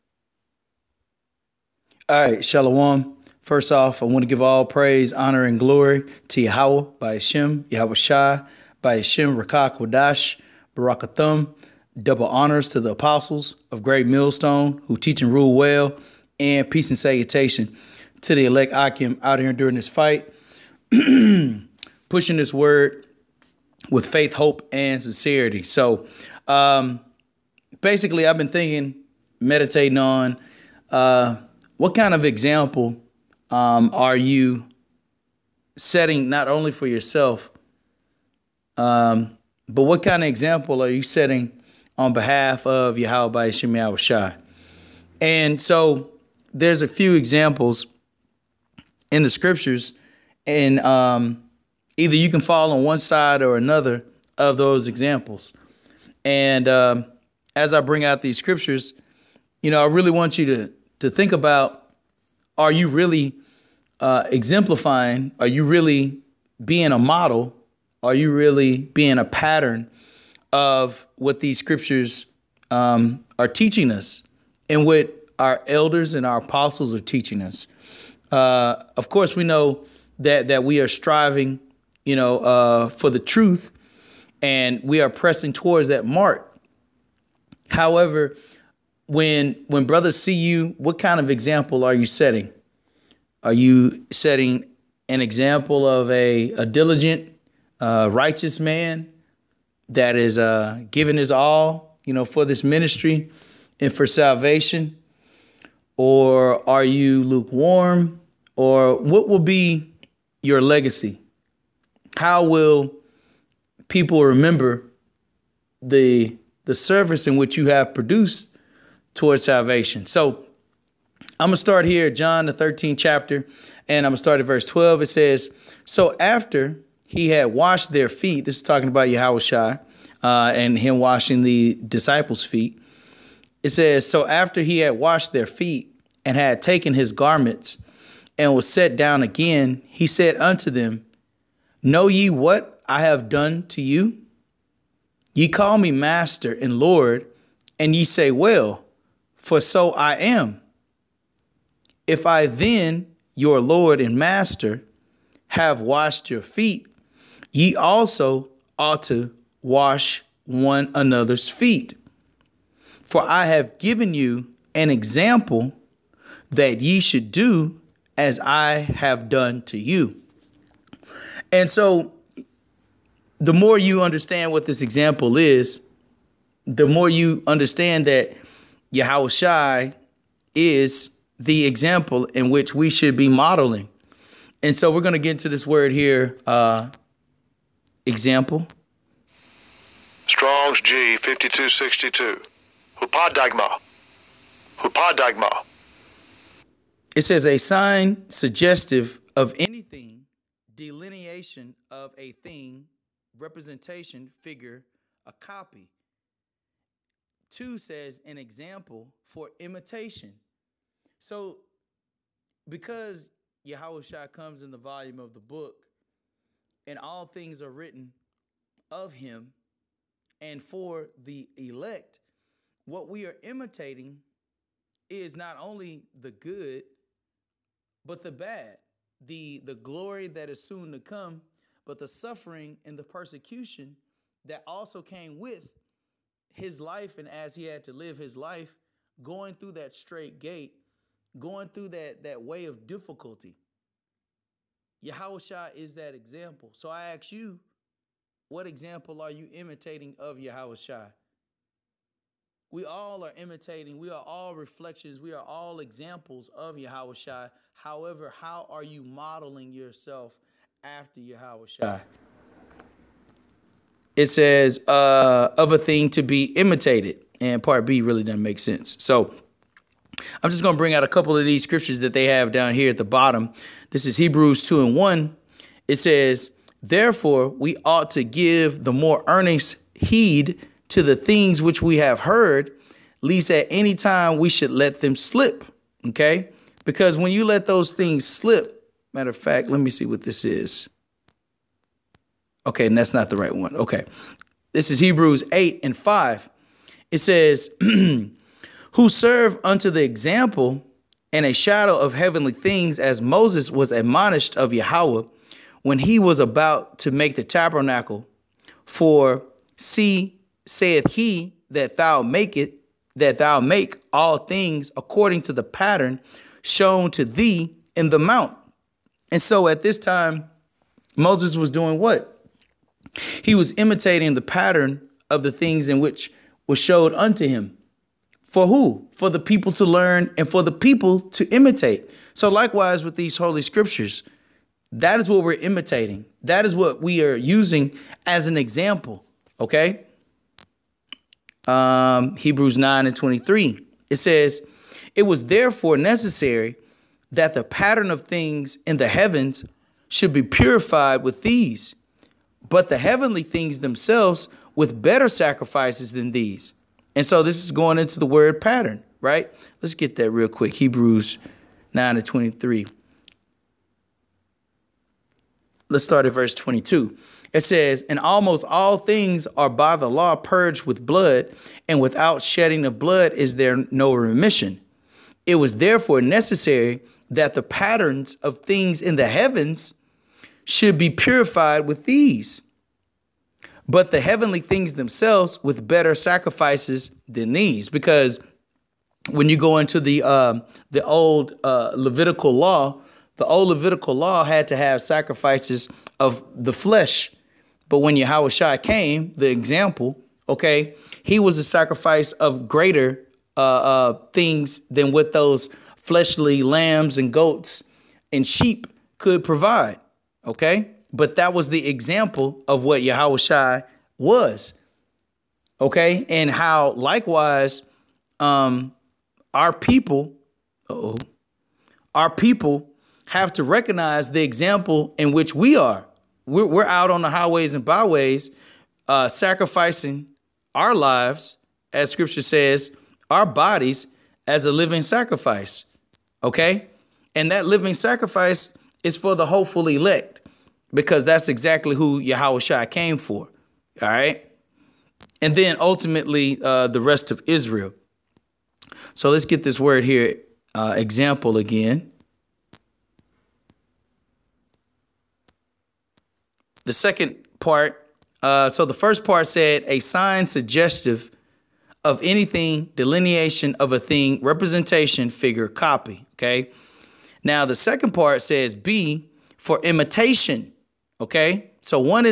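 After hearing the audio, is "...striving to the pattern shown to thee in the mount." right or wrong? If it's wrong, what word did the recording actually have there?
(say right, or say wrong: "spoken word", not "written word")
wrong: "according", not "striving".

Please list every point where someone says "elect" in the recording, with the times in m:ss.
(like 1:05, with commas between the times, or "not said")
0:18, 3:41, 7:19.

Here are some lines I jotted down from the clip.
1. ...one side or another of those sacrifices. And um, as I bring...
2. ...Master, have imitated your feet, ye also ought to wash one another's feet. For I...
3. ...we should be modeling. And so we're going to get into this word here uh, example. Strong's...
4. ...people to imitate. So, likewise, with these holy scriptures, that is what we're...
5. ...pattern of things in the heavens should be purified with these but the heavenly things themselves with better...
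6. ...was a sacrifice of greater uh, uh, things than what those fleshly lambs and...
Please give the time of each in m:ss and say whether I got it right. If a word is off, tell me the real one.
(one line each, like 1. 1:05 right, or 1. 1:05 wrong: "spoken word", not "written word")
1. 0:52 wrong: "examples", not "sacrifices"
2. 2:34 wrong: "washed", not "imitated"
3. 3:02 right
4. 5:30 right
5. 5:47 right
6. 6:41 right.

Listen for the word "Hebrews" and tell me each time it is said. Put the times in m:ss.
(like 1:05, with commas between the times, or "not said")
4:34, 4:54, 5:42, 6:00.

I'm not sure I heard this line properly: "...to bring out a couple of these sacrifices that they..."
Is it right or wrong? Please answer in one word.
wrong.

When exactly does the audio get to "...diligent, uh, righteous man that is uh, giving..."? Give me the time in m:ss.
1:36.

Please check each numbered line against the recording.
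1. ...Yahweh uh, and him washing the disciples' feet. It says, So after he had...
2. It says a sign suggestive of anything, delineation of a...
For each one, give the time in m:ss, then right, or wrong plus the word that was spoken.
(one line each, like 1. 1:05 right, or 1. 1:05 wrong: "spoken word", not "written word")
1. 2:09 right
2. 3:17 right.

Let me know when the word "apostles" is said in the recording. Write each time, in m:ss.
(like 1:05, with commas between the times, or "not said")
0:12, 1:16.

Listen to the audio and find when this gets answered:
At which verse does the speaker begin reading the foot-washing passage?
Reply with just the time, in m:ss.
2:04.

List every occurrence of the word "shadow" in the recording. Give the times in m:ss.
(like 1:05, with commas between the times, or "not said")
5:01.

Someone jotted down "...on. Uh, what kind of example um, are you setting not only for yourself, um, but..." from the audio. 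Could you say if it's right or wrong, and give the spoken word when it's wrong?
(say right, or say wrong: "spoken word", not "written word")
right.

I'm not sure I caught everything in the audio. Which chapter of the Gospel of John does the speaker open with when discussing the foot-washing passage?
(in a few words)
13th chapter.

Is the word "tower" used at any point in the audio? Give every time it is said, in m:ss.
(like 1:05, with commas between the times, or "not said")
not said.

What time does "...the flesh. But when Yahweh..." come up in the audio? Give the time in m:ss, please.
6:36.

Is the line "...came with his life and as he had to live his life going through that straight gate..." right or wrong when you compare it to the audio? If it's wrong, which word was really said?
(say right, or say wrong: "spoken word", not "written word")
right.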